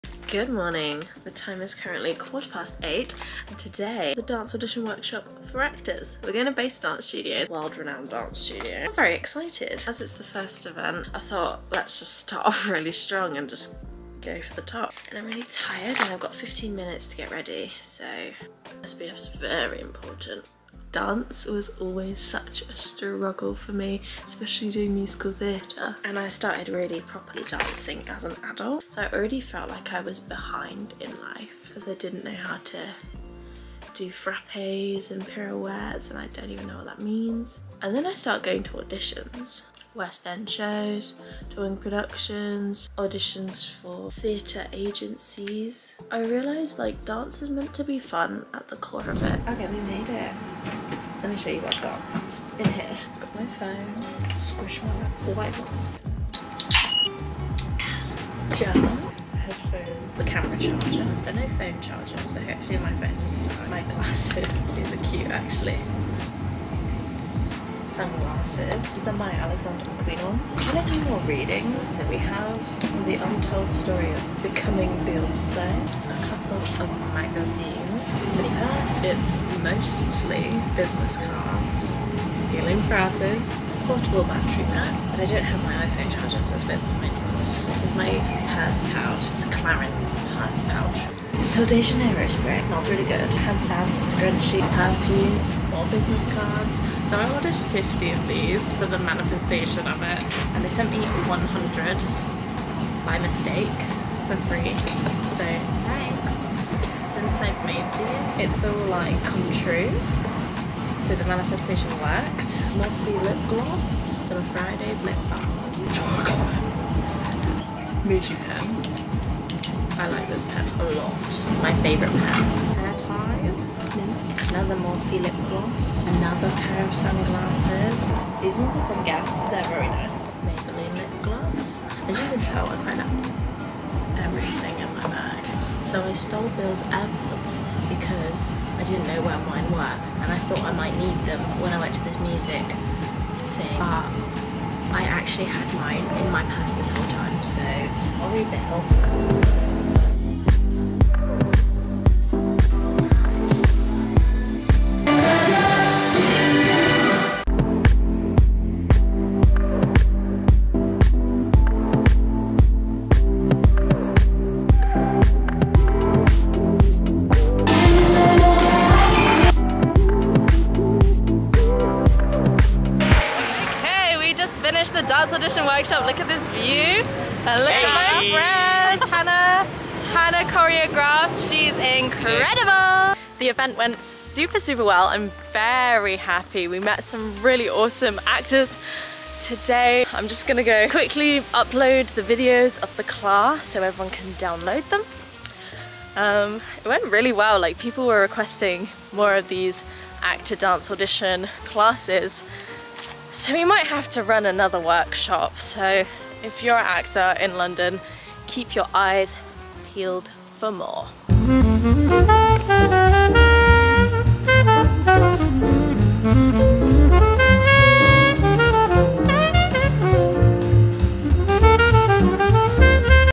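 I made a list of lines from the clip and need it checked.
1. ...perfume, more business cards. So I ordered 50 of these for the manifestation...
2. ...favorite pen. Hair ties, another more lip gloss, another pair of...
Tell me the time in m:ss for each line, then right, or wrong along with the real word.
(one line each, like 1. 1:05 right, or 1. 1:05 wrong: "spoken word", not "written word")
1. 1:34 right
2. 2:01 right.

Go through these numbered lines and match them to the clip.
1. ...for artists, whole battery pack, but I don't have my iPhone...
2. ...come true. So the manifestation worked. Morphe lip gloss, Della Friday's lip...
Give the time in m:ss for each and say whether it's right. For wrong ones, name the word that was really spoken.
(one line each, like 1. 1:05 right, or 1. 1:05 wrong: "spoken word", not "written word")
1. 1:22 wrong: "portable", not "whole"
2. 1:49 right.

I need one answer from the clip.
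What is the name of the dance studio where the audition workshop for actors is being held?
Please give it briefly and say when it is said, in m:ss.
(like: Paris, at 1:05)
Base Dance Studios, at 0:06.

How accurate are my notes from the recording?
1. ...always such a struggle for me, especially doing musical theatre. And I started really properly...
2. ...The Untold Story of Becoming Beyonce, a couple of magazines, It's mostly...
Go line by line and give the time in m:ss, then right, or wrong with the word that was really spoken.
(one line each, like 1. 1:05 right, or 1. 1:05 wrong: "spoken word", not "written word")
1. 0:21 right
2. 1:13 right.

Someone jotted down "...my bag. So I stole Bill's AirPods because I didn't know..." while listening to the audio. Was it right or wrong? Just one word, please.
right.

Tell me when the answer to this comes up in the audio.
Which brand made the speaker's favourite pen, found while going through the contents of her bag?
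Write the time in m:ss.
1:58.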